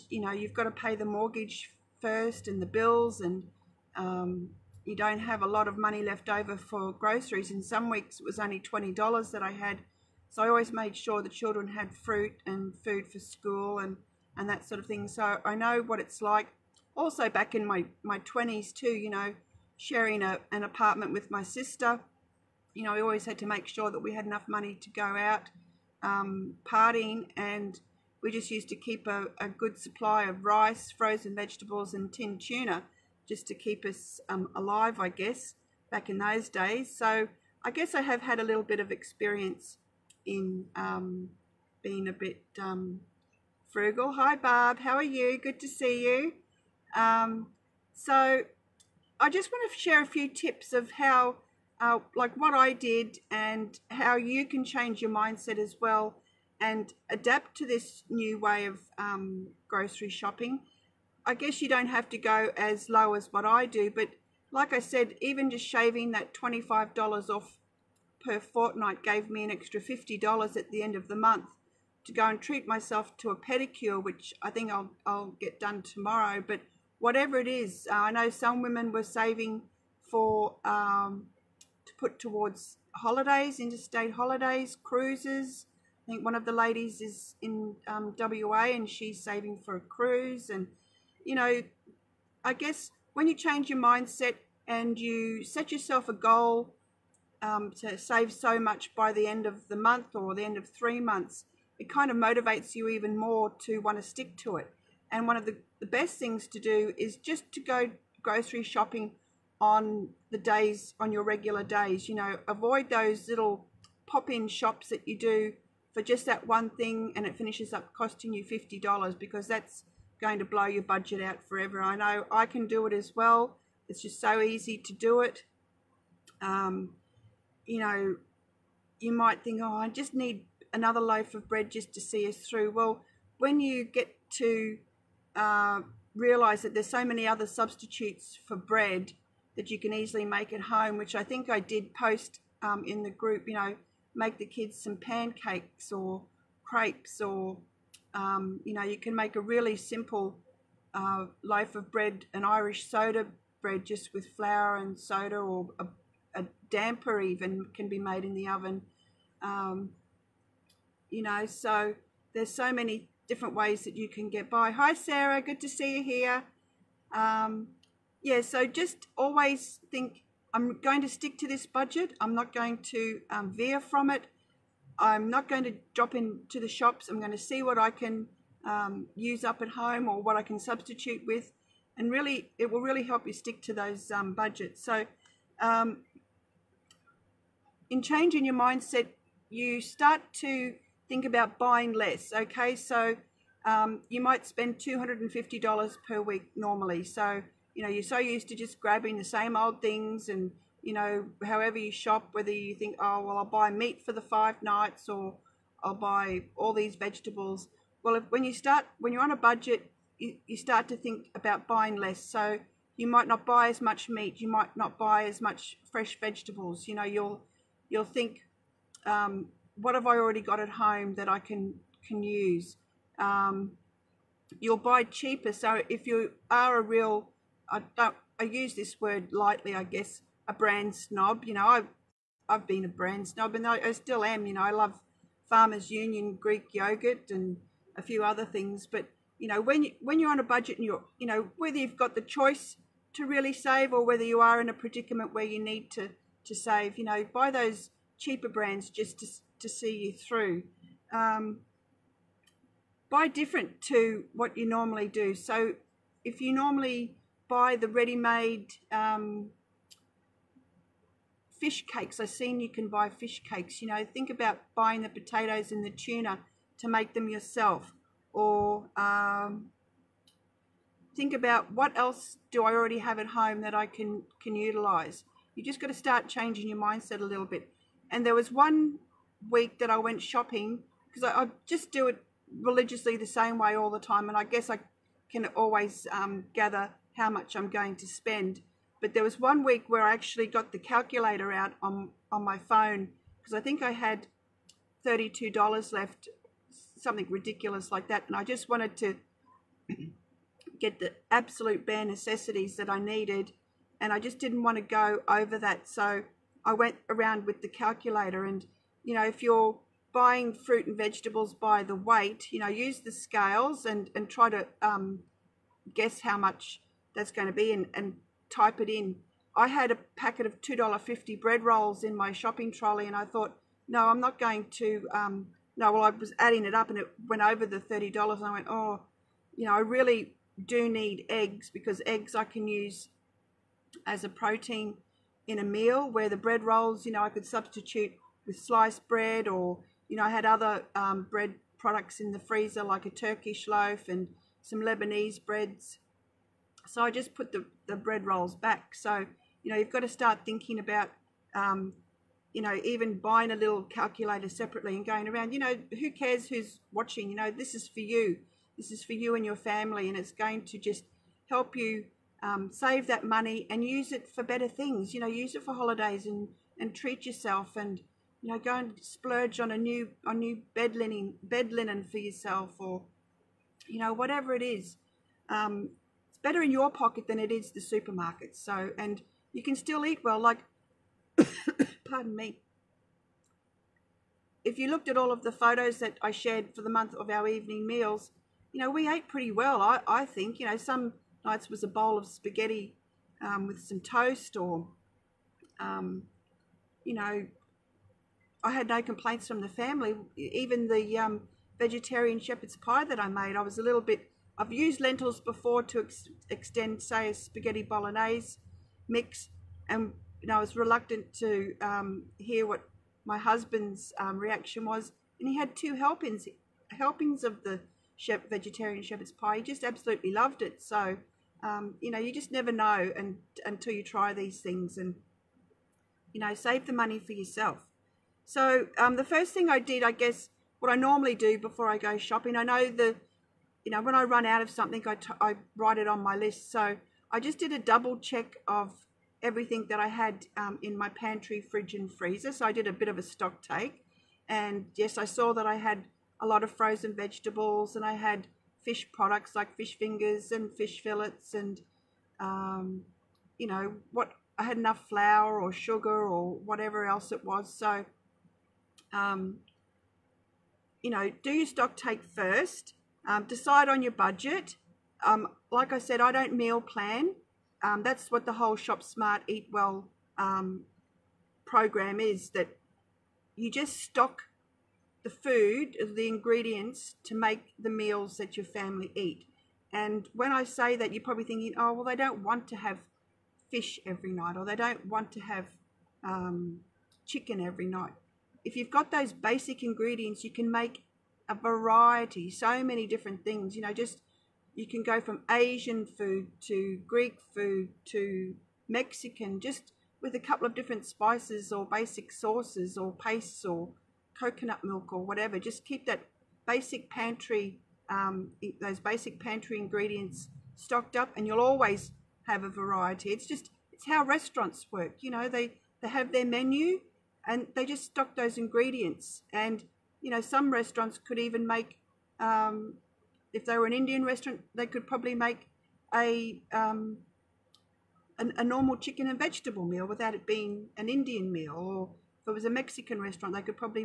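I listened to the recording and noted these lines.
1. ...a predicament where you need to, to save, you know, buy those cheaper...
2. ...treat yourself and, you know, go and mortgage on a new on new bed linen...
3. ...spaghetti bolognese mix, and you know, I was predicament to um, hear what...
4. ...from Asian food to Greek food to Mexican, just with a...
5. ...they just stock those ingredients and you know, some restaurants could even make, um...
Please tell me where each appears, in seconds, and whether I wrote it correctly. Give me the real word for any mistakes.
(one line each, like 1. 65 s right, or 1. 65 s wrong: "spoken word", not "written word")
1. 244 s right
2. 366 s wrong: "splurge", not "mortgage"
3. 407 s wrong: "reluctant", not "predicament"
4. 495 s right
5. 517 s right.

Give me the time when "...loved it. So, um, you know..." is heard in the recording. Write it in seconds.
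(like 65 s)
420 s.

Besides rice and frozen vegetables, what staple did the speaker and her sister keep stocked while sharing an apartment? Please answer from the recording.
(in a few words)
tin tuna.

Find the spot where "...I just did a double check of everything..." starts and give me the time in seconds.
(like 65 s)
437 s.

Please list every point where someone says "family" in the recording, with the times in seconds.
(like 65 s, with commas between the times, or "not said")
359 s, 399 s, 478 s.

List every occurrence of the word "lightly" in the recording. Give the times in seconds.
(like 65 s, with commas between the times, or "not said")
229 s.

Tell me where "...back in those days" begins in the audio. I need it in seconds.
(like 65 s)
35 s.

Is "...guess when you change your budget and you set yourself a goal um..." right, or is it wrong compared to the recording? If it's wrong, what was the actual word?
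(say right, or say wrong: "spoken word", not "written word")
wrong: "mindset", not "budget".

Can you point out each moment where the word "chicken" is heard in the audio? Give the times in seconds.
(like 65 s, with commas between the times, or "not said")
487 s, 528 s.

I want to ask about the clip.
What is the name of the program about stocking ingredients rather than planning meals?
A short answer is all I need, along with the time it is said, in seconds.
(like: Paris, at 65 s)
Shop Smart Eat Well, at 468 s.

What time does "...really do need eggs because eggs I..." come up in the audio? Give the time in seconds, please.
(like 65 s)
329 s.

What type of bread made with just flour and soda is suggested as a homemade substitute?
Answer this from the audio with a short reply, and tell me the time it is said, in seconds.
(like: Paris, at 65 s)
Irish soda bread, at 152 s.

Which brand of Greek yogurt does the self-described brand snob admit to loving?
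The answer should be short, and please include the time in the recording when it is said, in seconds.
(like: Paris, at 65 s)
Farmers Union, at 235 s.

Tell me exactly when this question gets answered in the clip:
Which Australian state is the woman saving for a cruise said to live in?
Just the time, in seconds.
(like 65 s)
88 s.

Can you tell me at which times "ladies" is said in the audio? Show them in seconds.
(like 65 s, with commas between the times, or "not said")
86 s.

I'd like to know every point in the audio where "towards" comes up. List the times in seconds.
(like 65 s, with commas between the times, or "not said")
82 s.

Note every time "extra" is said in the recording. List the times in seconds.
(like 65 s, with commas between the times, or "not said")
69 s.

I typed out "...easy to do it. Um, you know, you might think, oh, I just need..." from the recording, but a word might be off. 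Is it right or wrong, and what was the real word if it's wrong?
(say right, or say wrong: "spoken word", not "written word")
right.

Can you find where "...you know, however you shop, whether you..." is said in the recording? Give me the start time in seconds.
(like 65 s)
200 s.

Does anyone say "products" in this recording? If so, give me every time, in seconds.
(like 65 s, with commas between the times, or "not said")
341 s, 449 s.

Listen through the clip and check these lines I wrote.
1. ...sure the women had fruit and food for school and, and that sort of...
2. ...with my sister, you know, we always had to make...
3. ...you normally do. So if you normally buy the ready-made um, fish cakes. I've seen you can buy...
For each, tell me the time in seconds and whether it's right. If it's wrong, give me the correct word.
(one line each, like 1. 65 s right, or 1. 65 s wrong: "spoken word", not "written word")
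1. 10 s wrong: "children", not "women"
2. 21 s right
3. 254 s right.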